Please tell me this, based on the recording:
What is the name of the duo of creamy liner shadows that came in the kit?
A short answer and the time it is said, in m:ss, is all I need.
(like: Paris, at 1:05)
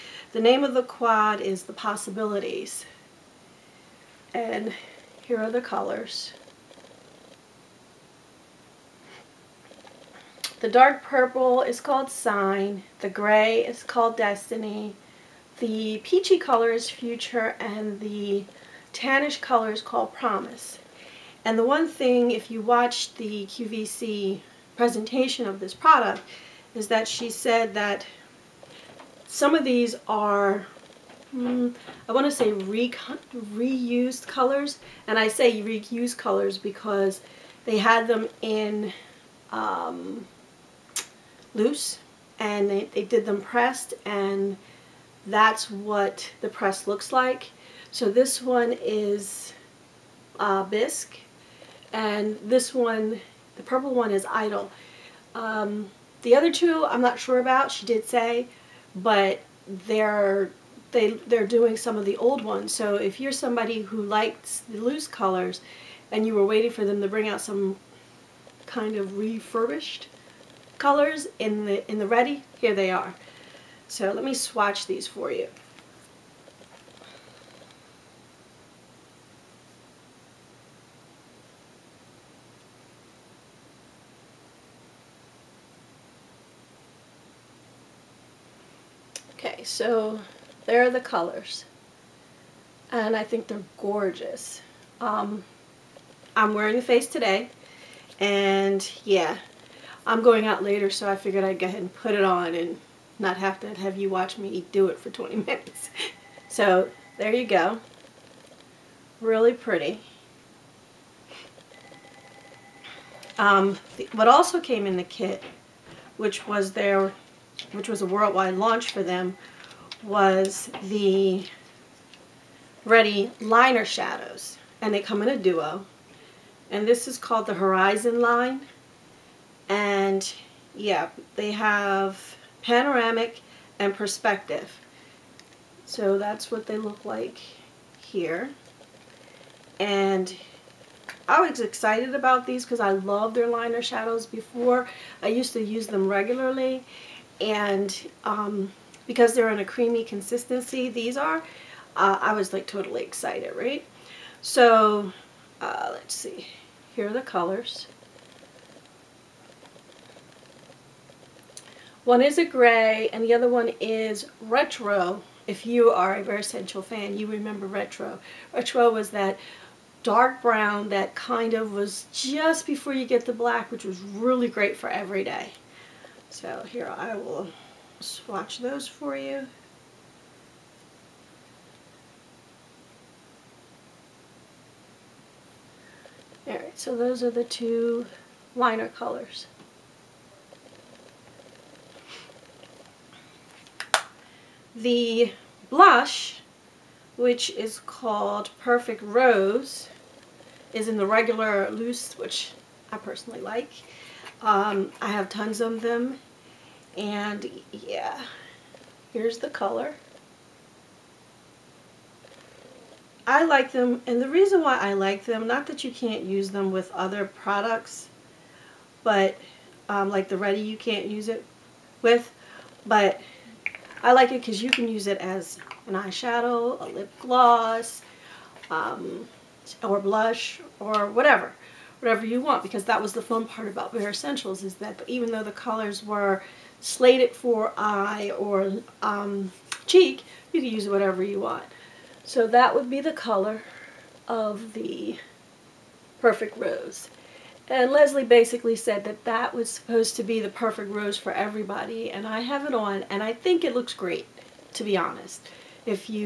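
Horizon, at 2:07.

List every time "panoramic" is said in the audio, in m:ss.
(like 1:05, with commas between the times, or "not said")
2:12.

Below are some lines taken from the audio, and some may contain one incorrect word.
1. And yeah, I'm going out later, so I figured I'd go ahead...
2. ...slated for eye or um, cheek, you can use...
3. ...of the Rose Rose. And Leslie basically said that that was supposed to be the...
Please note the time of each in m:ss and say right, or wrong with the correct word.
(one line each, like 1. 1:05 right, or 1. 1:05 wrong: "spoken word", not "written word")
1. 1:38 right
2. 3:56 right
3. 4:04 wrong: "Perfect", not "Rose".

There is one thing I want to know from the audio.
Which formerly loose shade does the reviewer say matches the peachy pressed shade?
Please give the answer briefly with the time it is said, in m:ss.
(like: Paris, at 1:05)
Bisque, at 0:50.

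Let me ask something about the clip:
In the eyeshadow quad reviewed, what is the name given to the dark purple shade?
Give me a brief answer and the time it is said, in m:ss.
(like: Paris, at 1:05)
Sign, at 0:12.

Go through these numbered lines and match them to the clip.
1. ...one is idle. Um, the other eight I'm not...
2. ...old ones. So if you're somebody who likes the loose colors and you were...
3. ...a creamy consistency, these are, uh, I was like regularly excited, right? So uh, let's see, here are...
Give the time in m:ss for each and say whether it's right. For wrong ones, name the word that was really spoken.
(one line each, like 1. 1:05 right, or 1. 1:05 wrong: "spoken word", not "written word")
1. 0:53 wrong: "two", not "eight"
2. 1:02 right
3. 2:29 wrong: "totally", not "regularly".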